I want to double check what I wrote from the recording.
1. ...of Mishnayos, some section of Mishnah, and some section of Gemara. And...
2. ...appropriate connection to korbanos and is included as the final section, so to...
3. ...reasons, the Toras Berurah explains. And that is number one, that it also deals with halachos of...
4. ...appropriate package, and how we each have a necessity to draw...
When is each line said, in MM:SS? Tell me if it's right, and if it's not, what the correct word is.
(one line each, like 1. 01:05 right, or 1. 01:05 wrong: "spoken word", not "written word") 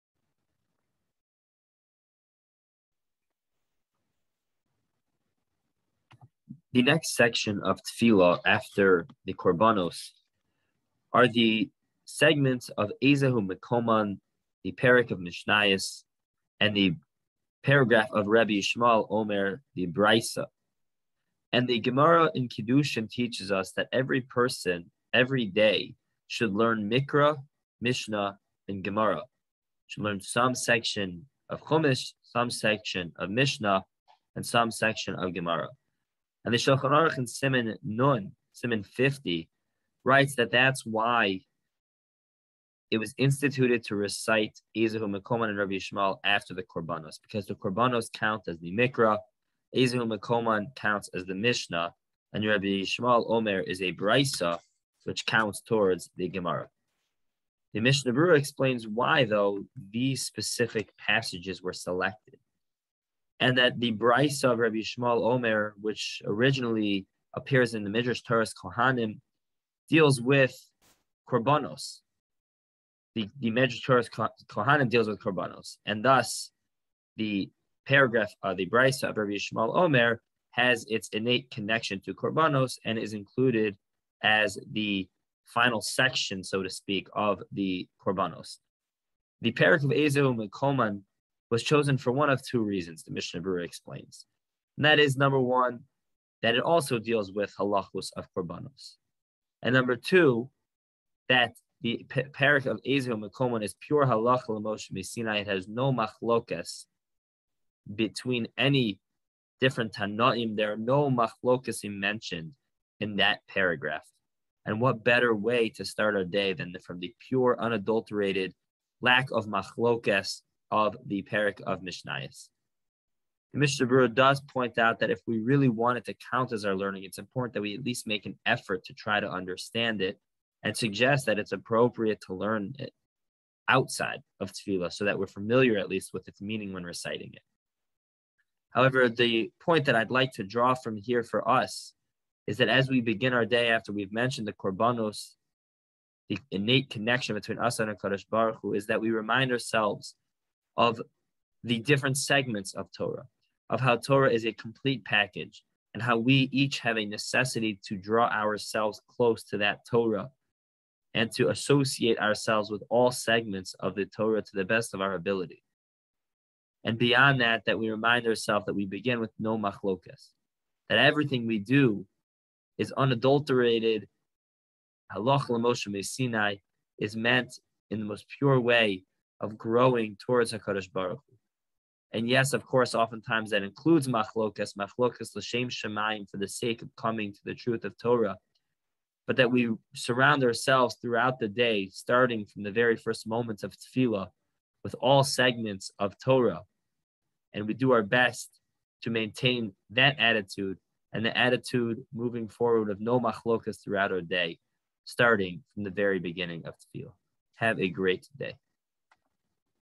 1. 00:31 wrong: "Chumash", not "Mishnayos"
2. 01:21 wrong: "innate", not "appropriate"
3. 01:32 wrong: "Mishnah", not "Toras"
4. 02:34 wrong: "complete", not "appropriate".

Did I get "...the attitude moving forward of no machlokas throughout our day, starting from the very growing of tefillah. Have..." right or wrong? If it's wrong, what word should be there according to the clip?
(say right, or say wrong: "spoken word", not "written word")
wrong: "beginning", not "growing".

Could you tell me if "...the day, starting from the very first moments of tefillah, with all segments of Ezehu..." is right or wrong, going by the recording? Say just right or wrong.
wrong.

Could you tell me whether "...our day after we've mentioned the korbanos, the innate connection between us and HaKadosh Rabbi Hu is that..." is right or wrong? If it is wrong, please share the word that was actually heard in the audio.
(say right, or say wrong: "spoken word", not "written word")
wrong: "Baruch", not "Rabbi".